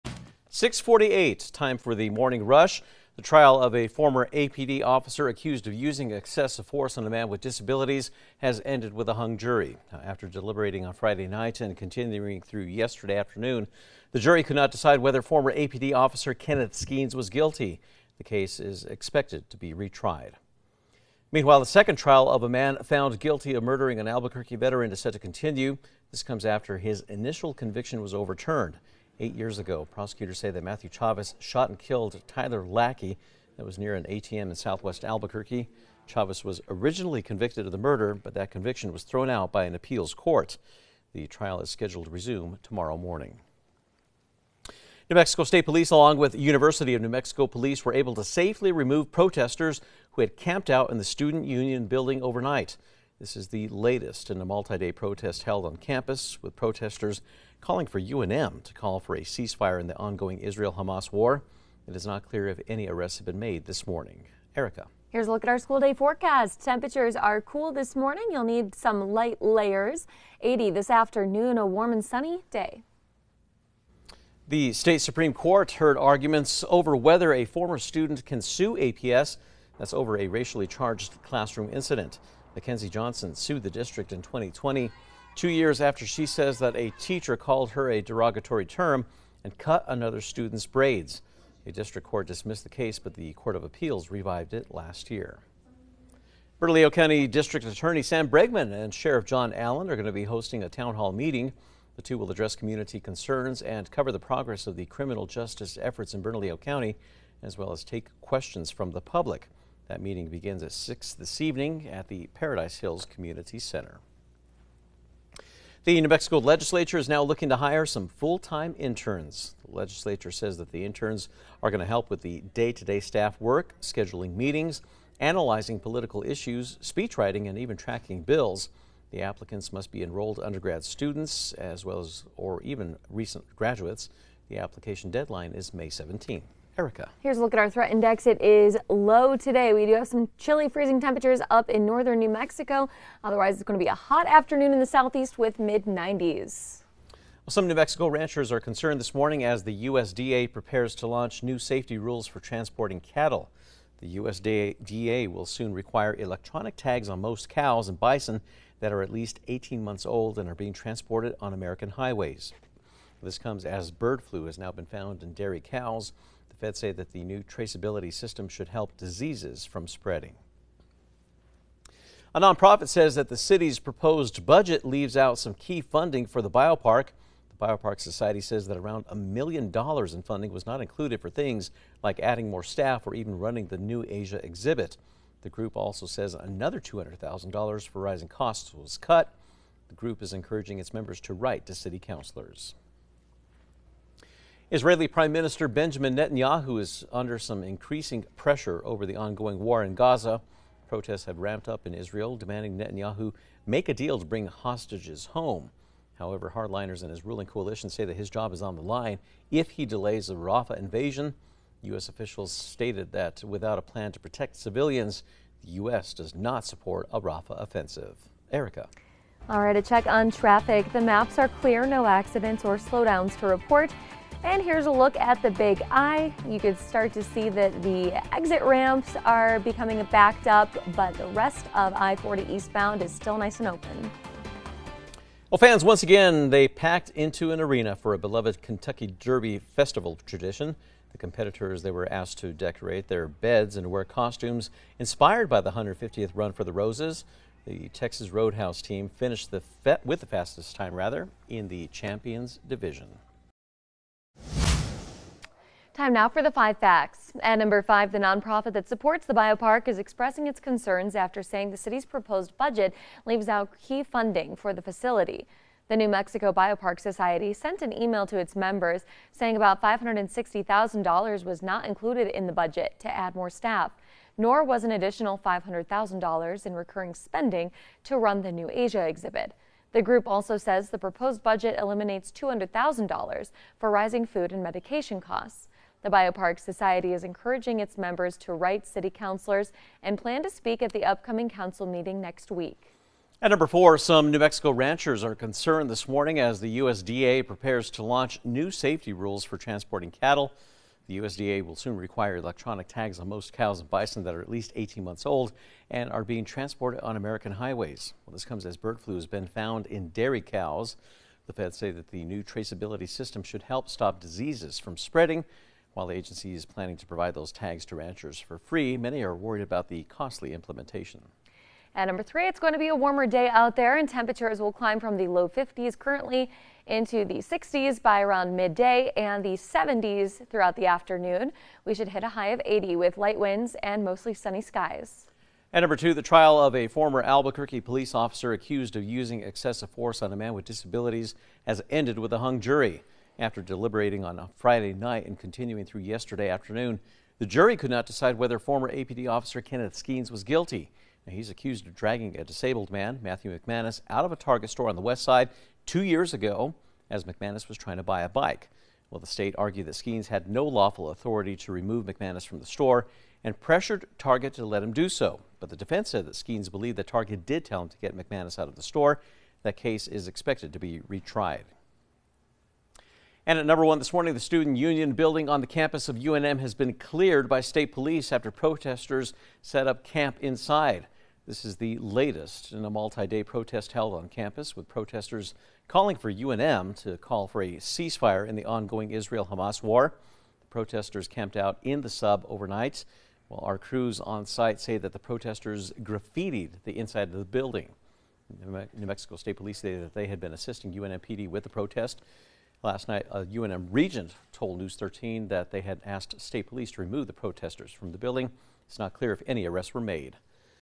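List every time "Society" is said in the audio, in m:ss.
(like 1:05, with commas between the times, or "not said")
2:57, 4:27, 4:46.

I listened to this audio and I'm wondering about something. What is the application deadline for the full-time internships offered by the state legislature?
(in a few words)
May 17th.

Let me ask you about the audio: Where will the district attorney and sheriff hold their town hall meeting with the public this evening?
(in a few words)
Paradise Hills Community Center.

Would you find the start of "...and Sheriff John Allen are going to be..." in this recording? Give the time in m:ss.
1:38.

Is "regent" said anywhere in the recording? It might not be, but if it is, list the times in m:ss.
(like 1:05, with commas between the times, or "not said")
6:43.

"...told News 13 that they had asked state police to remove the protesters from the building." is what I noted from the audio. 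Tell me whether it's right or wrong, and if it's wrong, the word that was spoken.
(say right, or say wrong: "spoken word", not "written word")
right.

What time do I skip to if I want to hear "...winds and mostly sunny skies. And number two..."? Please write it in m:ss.
5:33.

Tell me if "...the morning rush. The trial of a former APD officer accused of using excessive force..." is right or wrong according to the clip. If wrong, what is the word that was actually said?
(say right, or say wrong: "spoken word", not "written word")
right.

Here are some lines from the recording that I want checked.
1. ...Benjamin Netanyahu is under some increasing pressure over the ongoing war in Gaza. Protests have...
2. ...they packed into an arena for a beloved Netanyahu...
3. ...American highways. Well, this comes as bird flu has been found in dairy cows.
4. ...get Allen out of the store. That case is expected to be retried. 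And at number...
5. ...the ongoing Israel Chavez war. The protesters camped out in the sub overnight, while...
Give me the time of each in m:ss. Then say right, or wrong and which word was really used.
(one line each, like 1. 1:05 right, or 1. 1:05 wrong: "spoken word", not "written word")
1. 3:15 right
2. 3:56 wrong: "Kentucky", not "Netanyahu"
3. 5:07 right
4. 6:07 wrong: "McManus", not "Allen"
5. 6:28 wrong: "Hamas", not "Chavez".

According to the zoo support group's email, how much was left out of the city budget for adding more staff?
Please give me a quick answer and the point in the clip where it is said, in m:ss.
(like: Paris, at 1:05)
$560,000, at 4:29.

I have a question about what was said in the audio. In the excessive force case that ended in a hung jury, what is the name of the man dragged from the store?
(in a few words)
Matthew McManus.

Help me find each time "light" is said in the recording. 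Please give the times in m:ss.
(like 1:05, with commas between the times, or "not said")
1:09, 5:33.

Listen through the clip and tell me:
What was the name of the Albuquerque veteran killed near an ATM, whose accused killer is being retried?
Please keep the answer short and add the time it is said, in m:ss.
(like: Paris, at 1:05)
Tyler Lackey, at 0:32.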